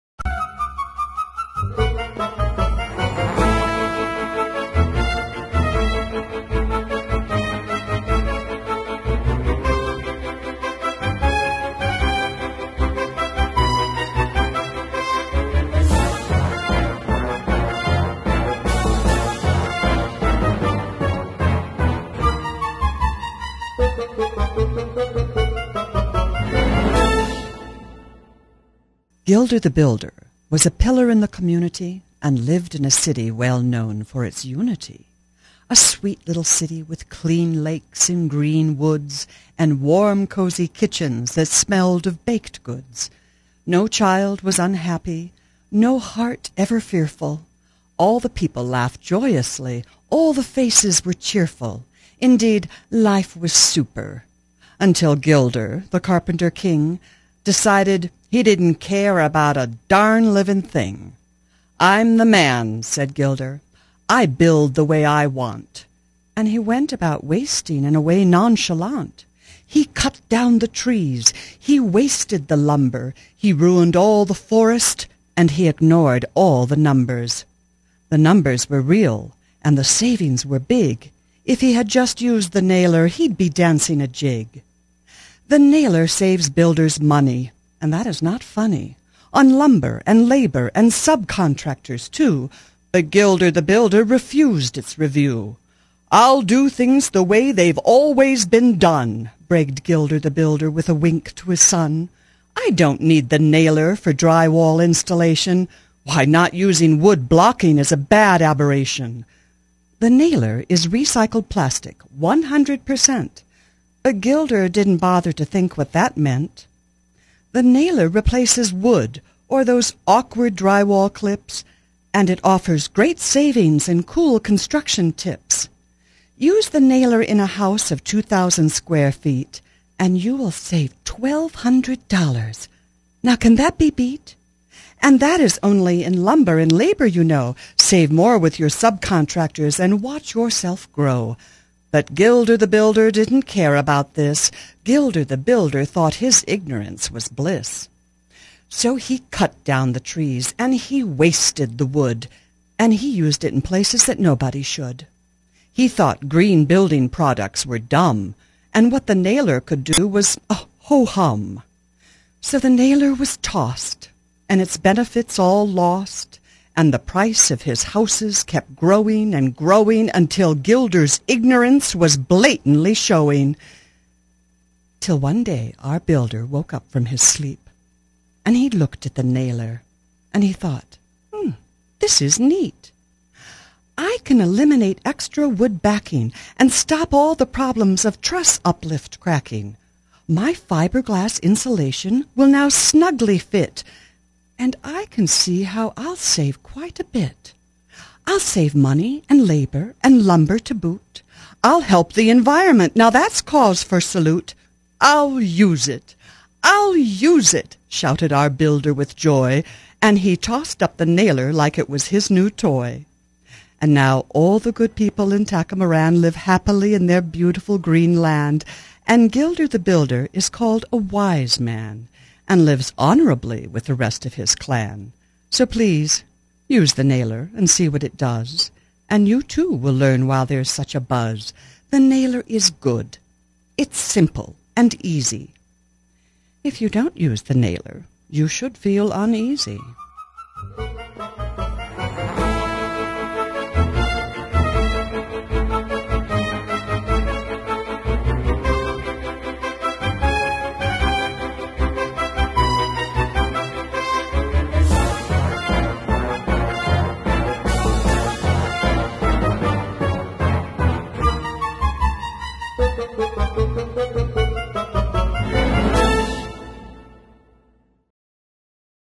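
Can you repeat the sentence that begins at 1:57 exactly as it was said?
The nailer replaces wood or those awkward drywall clips, and it offers great savings and cool construction tips.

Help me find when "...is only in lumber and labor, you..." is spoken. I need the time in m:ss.
2:15.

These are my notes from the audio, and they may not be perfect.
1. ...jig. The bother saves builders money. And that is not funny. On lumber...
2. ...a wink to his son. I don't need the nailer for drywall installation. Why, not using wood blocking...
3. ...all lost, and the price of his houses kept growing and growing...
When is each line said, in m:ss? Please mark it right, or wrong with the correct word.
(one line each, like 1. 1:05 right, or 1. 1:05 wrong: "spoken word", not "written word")
1. 1:24 wrong: "nailer", not "bother"
2. 1:40 right
3. 2:45 right.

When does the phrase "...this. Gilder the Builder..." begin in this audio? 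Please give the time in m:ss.
2:24.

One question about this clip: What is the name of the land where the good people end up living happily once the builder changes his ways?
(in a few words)
Tacamoran.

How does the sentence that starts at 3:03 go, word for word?
I can eliminate extra wood backing and stop all the problems of truss uplift cracking.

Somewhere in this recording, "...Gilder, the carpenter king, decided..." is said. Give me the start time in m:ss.
0:55.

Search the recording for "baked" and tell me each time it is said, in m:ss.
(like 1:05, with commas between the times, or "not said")
0:42.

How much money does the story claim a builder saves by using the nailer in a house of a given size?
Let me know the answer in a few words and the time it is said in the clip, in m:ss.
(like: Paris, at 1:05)
$1,200, at 2:11.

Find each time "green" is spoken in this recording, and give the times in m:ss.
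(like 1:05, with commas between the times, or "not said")
0:38, 2:36, 3:37.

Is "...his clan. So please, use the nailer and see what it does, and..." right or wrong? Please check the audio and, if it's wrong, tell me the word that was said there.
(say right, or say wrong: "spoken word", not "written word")
right.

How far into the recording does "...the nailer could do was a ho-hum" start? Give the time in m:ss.
2:39.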